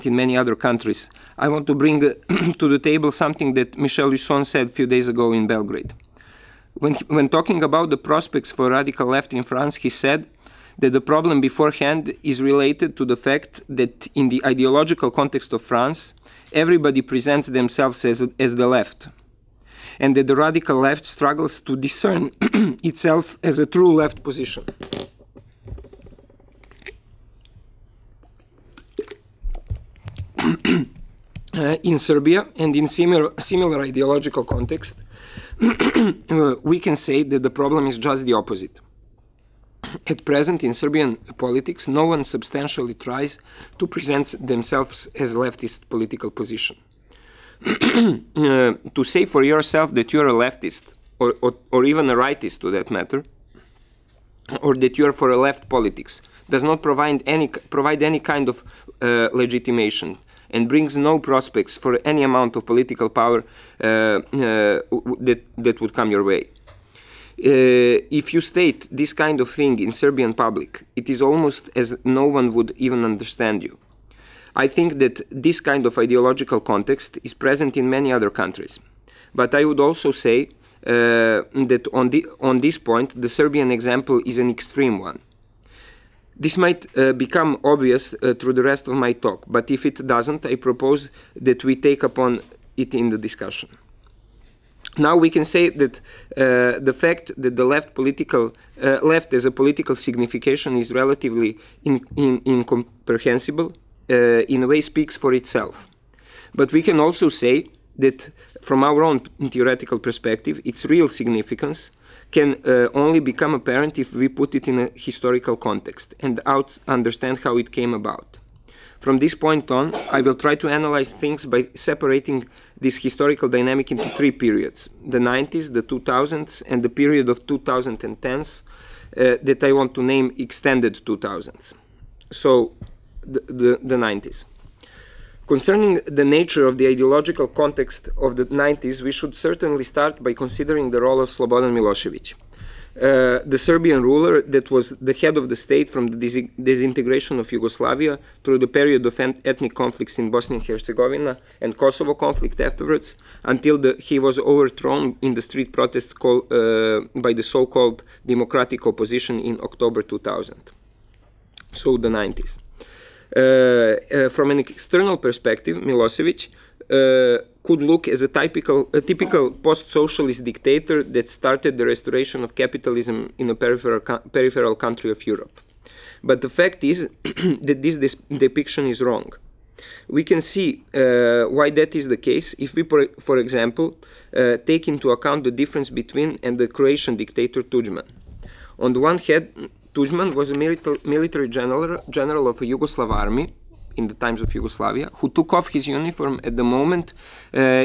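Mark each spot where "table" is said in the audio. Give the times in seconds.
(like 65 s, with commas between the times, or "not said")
2 s.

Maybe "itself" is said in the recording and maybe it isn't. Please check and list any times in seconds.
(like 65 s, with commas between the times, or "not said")
22 s, 105 s.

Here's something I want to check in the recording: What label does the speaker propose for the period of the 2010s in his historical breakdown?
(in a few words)
extended 2000s.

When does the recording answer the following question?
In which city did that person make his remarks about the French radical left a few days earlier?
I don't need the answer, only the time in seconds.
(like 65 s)
5 s.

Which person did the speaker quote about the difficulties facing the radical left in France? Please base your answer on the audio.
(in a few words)
Michel Husson.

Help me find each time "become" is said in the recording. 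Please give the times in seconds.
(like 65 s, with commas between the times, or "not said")
87 s, 113 s.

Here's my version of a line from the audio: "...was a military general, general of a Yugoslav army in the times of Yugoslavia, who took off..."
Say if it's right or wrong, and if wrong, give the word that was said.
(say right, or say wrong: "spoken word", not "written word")
right.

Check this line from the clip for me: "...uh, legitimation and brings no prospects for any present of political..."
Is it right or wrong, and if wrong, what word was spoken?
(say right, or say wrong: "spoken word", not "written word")
wrong: "amount", not "present".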